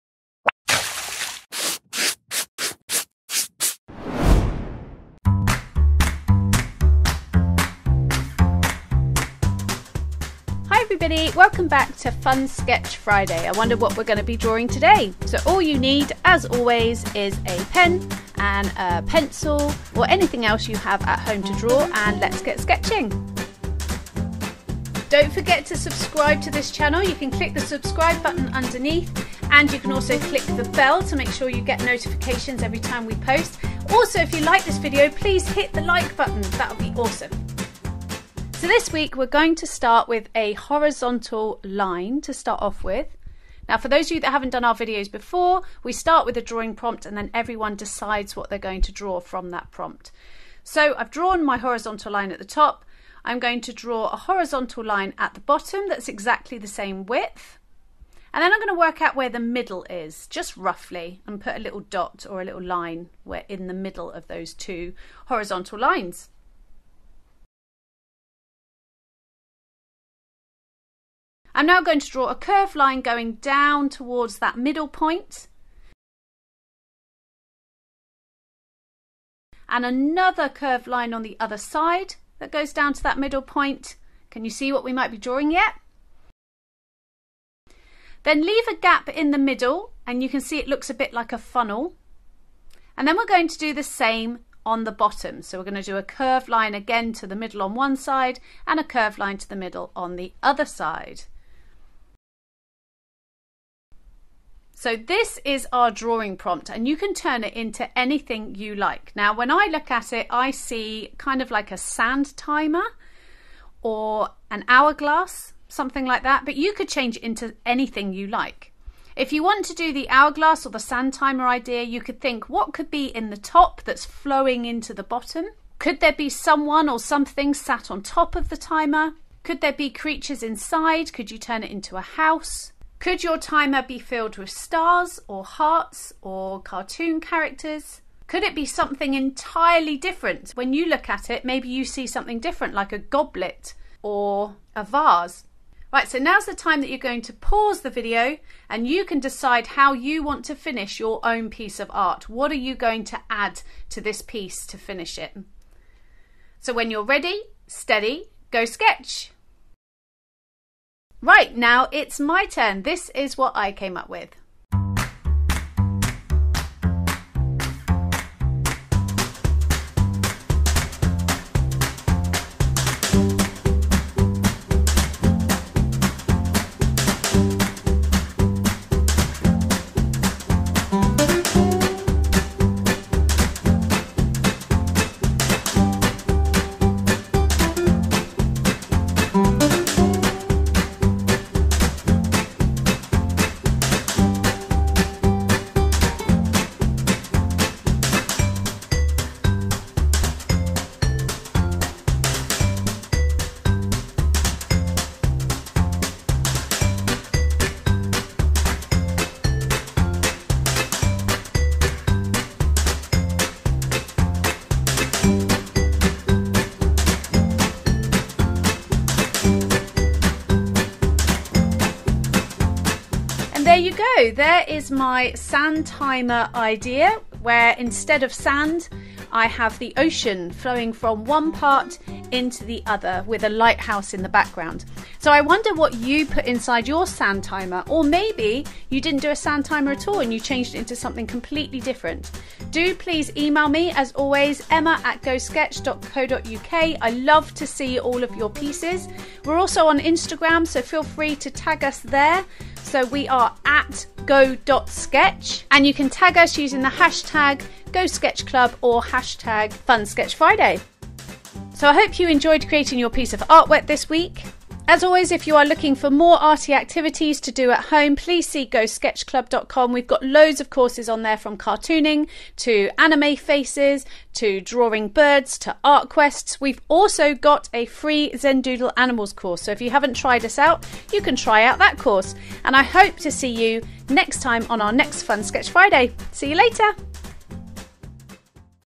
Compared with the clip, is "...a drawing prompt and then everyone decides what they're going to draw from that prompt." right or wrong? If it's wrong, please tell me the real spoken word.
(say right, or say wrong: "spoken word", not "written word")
right.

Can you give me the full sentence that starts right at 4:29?
We've got loads of courses on there from cartooning to anime faces to drawing birds to art quests.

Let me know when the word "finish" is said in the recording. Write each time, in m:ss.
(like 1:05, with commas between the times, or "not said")
2:30, 2:34.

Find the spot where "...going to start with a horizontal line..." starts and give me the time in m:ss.
0:39.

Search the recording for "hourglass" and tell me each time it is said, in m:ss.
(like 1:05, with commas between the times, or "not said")
1:54, 2:00.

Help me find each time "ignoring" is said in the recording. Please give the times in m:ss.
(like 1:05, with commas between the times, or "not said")
not said.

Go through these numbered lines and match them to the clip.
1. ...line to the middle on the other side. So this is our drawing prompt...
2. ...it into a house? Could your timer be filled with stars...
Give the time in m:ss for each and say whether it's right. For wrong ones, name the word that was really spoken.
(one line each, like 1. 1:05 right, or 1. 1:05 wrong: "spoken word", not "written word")
1. 1:39 right
2. 2:11 right.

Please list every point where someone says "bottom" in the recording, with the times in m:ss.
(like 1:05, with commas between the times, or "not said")
0:55, 1:34, 2:05.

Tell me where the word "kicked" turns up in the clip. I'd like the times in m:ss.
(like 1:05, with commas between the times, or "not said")
not said.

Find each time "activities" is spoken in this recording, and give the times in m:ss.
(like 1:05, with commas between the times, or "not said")
4:26.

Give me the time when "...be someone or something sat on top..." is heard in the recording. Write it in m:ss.
2:06.